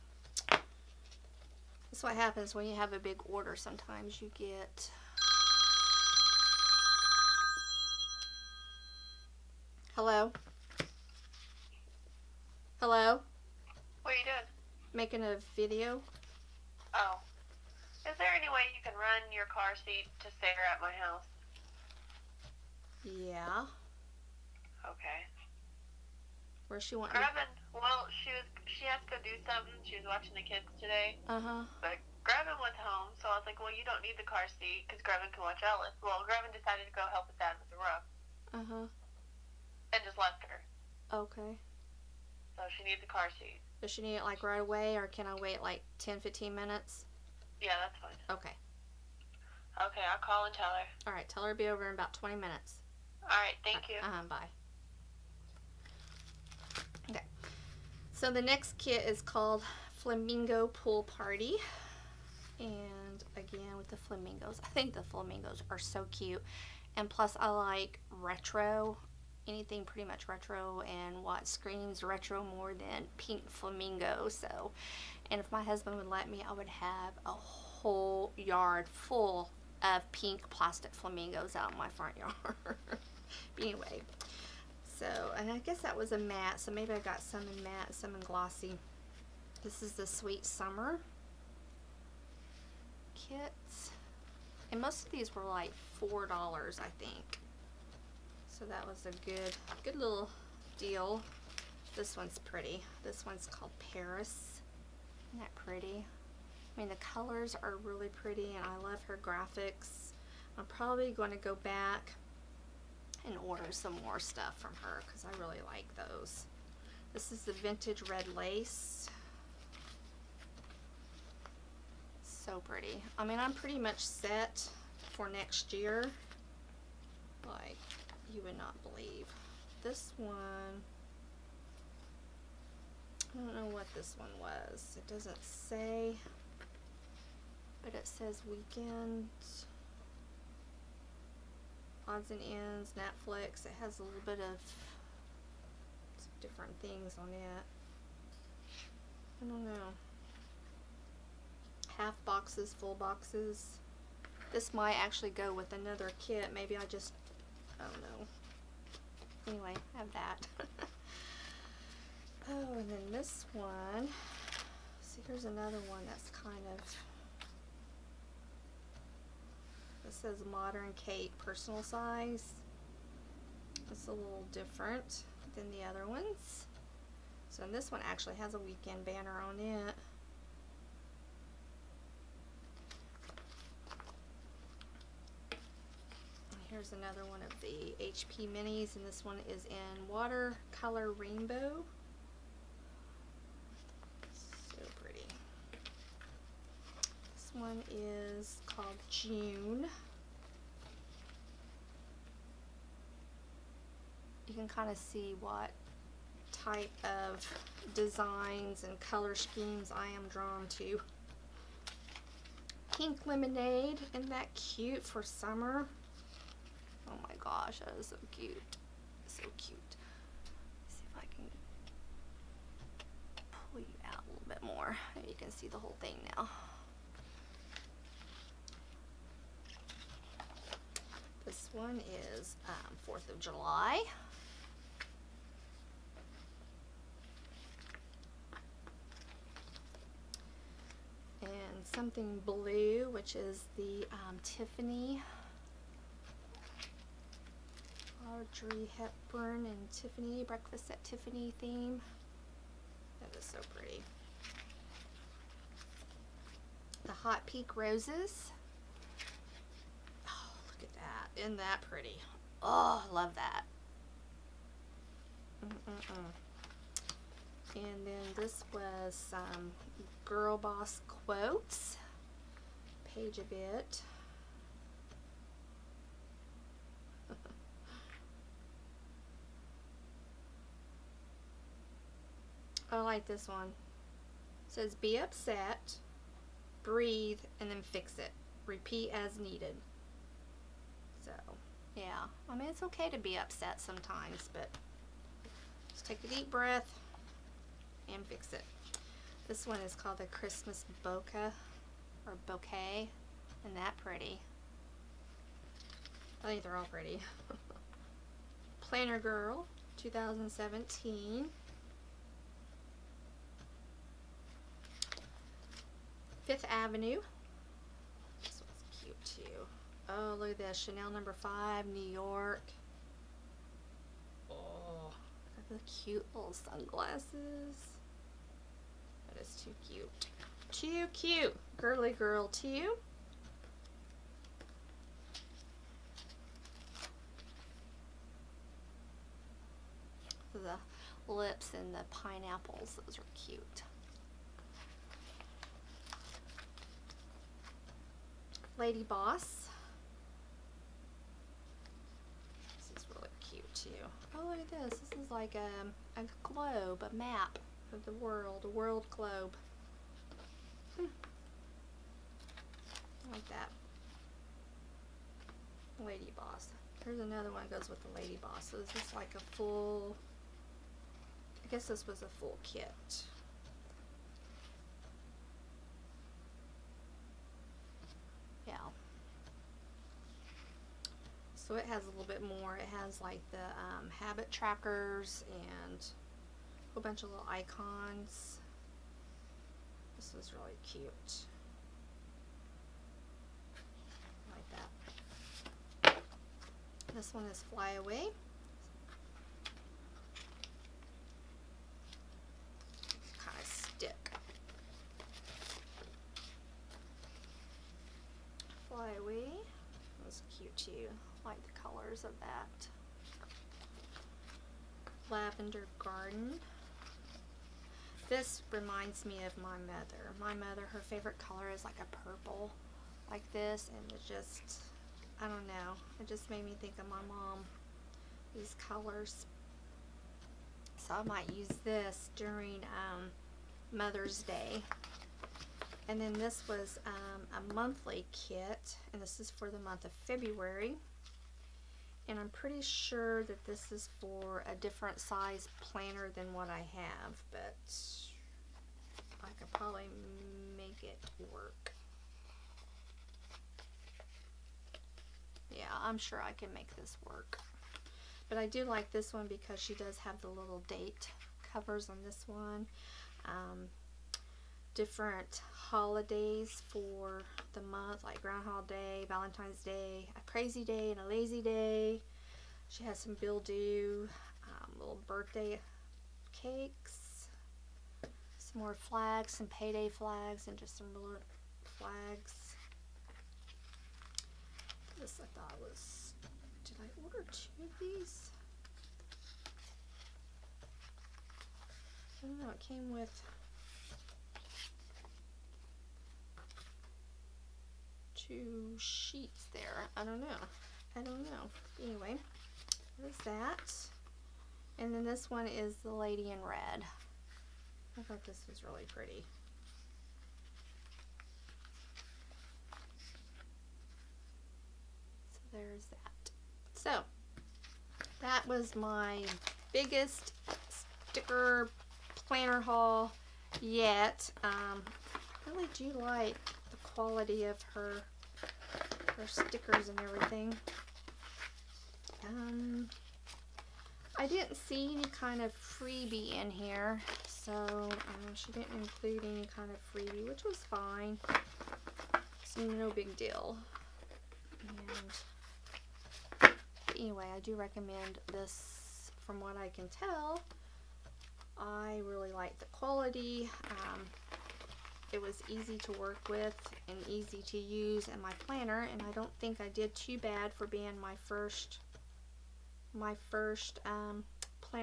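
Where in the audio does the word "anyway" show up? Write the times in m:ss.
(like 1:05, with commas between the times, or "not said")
1:23, 2:39, 8:22, 9:07.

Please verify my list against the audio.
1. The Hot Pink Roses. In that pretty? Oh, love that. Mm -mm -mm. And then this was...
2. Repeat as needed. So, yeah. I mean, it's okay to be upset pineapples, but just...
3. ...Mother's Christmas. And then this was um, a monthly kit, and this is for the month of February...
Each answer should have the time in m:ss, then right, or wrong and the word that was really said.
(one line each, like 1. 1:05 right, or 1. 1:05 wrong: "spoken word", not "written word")
1. 4:17 right
2. 4:48 wrong: "sometimes", not "pineapples"
3. 7:13 wrong: "Day", not "Christmas".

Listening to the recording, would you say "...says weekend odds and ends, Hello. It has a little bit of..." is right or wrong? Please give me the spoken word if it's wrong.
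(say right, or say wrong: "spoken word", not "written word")
wrong: "Netflix", not "Hello".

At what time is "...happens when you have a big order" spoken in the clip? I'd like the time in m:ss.
0:02.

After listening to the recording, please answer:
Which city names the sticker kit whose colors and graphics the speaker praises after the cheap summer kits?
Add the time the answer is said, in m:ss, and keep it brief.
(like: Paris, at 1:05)
Paris, at 1:43.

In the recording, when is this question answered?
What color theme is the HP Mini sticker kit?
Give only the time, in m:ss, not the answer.
3:10.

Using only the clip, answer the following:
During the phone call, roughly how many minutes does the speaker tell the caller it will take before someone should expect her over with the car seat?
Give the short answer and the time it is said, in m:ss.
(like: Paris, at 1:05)
20 minutes, at 0:52.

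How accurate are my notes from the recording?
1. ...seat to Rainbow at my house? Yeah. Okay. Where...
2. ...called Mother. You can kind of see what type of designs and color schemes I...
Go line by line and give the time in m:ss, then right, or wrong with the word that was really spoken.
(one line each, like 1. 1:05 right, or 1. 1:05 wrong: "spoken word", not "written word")
1. 0:19 wrong: "Sarah", not "Rainbow"
2. 3:18 wrong: "June", not "Mother".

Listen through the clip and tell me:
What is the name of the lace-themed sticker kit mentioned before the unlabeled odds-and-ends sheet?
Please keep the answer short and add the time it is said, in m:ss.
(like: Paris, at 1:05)
Vintage red lace, at 1:57.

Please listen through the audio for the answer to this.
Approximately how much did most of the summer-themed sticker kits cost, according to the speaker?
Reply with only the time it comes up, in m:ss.
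1:36.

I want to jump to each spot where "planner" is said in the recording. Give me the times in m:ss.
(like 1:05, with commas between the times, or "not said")
5:08, 7:25, 8:42, 9:18.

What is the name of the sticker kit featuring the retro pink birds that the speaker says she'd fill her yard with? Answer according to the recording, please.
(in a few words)
Flamingo Pool Party.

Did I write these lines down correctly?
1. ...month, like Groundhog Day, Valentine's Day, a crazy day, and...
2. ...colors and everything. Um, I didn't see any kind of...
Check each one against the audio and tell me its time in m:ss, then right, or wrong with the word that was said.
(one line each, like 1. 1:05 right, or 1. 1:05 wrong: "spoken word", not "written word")
1. 7:47 right
2. 8:49 wrong: "stickers", not "colors".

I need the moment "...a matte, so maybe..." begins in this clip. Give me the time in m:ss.
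1:26.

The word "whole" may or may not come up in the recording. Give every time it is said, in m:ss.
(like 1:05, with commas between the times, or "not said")
1:17, 3:45, 6:26.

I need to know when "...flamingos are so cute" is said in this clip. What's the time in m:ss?
1:05.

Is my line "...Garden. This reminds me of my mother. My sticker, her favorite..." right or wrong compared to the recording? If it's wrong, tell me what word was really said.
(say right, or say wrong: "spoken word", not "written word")
wrong: "mother", not "sticker".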